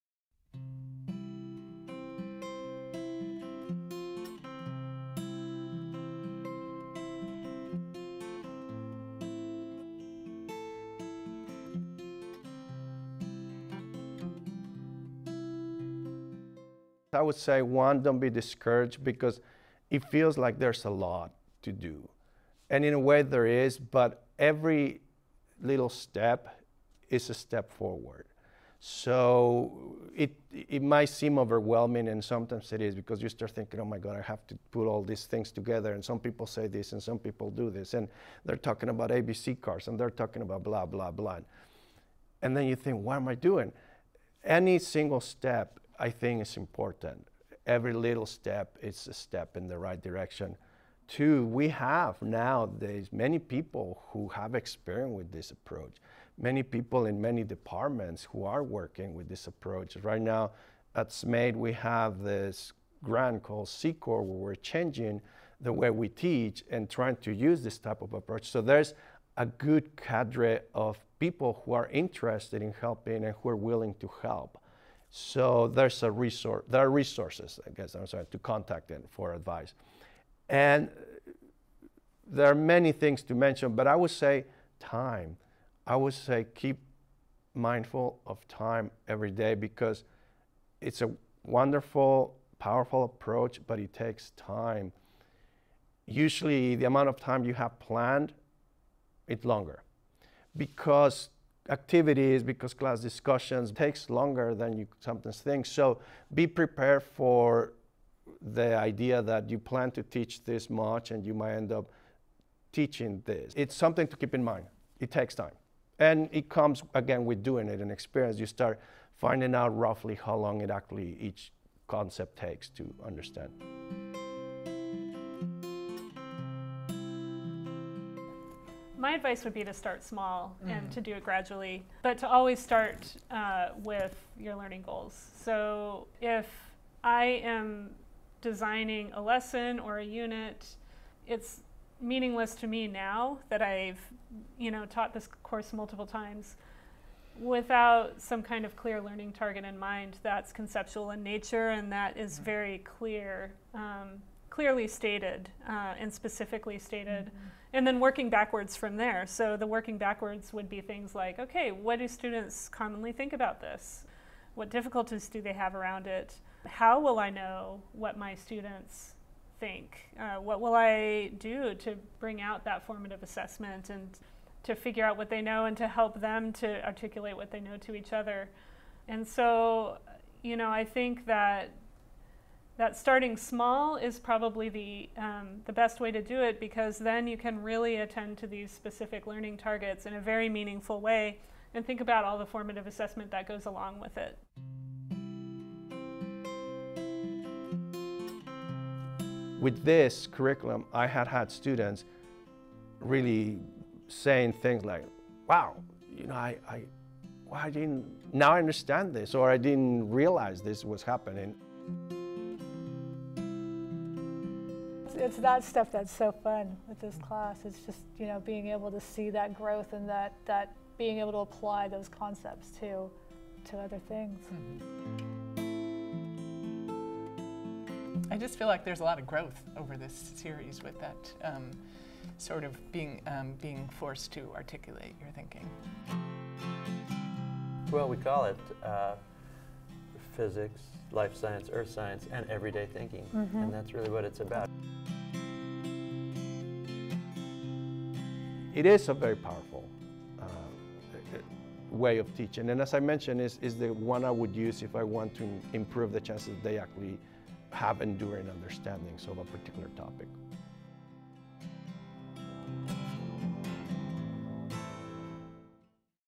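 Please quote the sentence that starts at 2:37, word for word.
Mm-hmm and then working backwards from there.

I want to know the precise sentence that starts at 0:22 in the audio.
And in a way, there is, but every little step is a step forward.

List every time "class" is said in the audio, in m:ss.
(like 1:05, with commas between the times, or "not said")
1:42, 3:37.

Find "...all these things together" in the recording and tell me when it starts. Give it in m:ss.
0:34.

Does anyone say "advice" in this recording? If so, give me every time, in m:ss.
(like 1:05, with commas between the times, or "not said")
1:19, 2:09.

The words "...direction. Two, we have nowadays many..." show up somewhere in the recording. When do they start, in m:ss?
0:50.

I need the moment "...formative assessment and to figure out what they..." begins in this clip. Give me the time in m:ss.
2:52.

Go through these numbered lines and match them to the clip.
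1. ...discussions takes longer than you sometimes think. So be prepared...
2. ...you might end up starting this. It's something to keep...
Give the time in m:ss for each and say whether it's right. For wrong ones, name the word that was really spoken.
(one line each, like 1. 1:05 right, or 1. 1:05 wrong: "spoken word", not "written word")
1. 1:42 right
2. 1:51 wrong: "teaching", not "starting".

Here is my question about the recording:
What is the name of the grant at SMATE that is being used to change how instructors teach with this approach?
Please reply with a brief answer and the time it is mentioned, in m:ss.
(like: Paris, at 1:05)
C-Core, at 1:03.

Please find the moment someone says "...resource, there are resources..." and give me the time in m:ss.
1:16.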